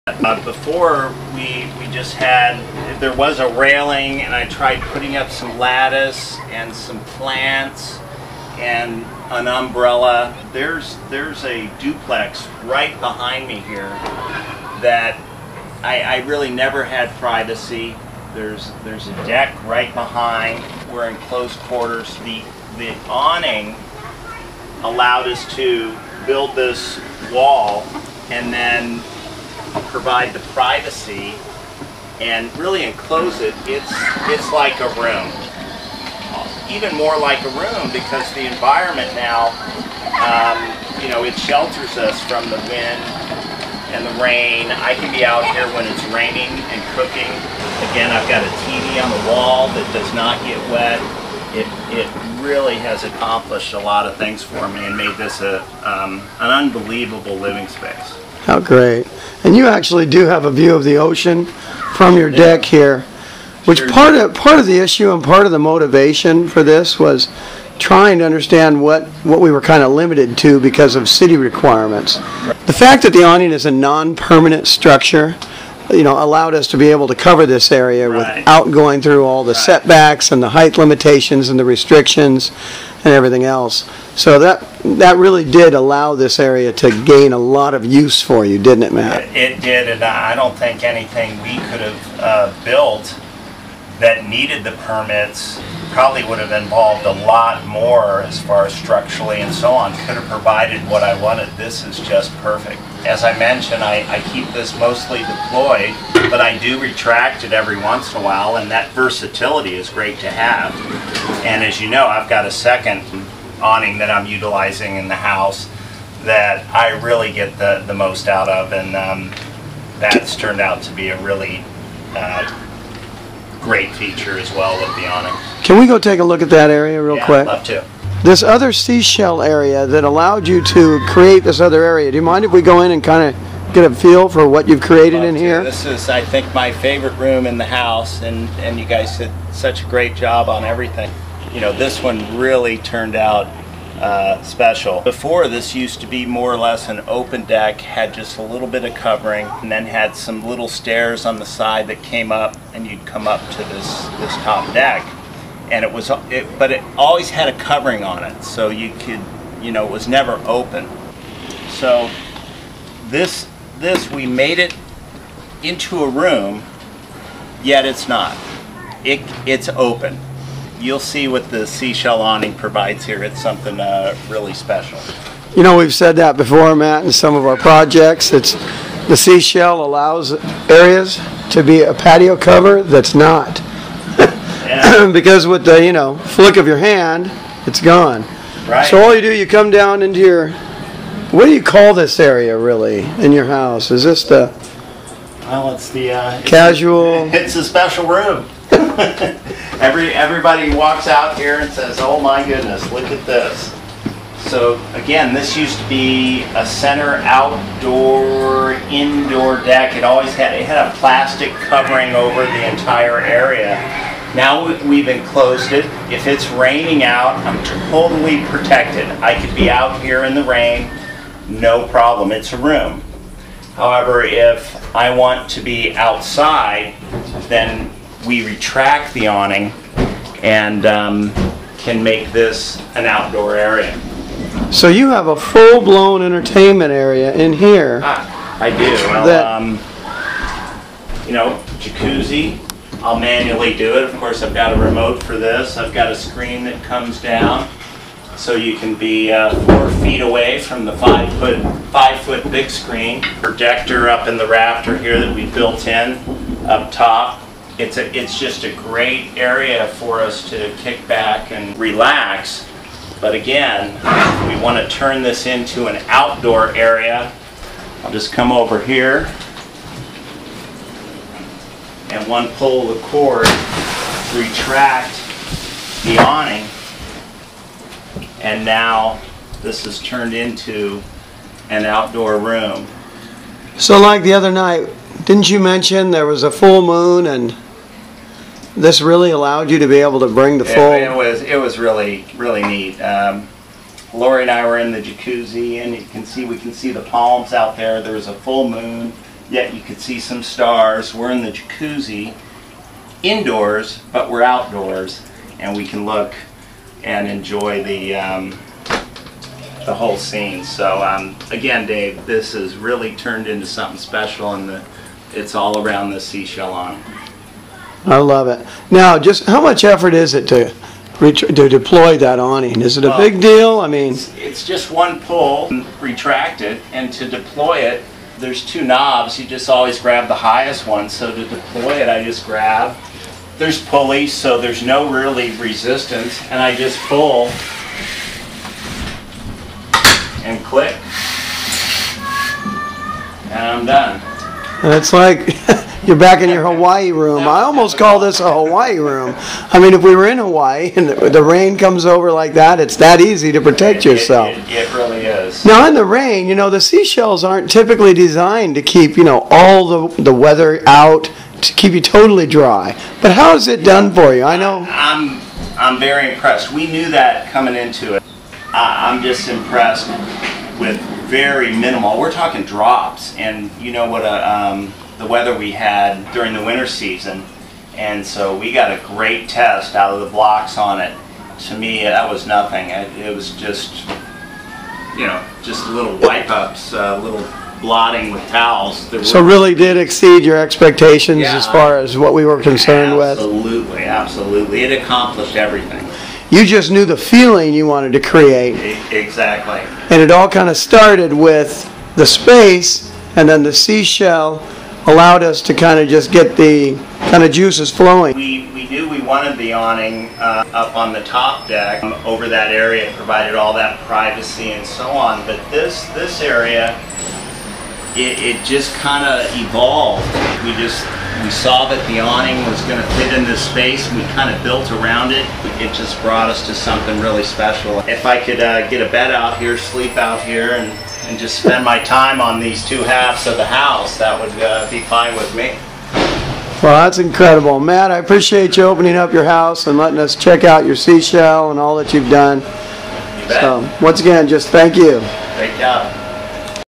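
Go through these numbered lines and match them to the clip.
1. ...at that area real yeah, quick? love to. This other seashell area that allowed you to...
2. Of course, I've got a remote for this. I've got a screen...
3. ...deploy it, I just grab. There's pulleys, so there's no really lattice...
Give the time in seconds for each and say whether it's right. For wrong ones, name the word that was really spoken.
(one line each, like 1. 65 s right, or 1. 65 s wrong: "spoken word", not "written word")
1. 126 s right
2. 244 s right
3. 331 s wrong: "resistance", not "lattice".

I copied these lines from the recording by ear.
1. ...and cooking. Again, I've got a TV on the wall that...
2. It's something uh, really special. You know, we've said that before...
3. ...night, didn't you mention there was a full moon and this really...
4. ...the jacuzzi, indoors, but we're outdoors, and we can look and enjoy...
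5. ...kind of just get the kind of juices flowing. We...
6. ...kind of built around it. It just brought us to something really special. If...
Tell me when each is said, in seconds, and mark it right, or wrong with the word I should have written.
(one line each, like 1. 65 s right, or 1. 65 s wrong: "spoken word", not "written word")
1. 46 s right
2. 173 s right
3. 284 s right
4. 301 s right
5. 405 s right
6. 424 s right.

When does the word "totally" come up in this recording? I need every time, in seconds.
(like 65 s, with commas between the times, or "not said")
217 s, 362 s.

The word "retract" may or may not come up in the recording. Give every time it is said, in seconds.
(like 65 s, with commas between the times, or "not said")
106 s, 228 s, 274 s, 325 s.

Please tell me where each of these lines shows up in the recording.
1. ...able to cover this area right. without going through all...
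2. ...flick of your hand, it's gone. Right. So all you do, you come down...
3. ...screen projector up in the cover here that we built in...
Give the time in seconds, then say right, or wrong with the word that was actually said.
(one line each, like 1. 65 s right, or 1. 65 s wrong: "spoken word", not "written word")
1. 76 s right
2. 186 s right
3. 252 s wrong: "rafter", not "cover".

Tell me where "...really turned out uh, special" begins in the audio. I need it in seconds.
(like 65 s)
142 s.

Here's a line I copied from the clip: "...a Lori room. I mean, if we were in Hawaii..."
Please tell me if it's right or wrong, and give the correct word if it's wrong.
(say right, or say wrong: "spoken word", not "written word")
wrong: "Hawaii", not "Lori".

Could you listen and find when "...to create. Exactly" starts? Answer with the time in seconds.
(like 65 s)
398 s.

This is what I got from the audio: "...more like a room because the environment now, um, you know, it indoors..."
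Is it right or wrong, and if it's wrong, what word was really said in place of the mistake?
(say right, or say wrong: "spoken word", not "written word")
wrong: "shelters", not "indoors".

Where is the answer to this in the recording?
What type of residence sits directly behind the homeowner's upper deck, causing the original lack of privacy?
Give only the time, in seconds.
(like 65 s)
11 s.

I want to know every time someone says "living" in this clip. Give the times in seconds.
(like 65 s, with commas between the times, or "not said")
57 s.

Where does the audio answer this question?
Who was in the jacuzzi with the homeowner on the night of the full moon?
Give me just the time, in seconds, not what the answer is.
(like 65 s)
294 s.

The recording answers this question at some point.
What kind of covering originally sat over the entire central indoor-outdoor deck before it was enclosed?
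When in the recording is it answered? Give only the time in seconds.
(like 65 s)
210 s.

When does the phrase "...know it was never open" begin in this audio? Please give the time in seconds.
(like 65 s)
159 s.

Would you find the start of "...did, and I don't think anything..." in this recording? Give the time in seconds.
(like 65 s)
89 s.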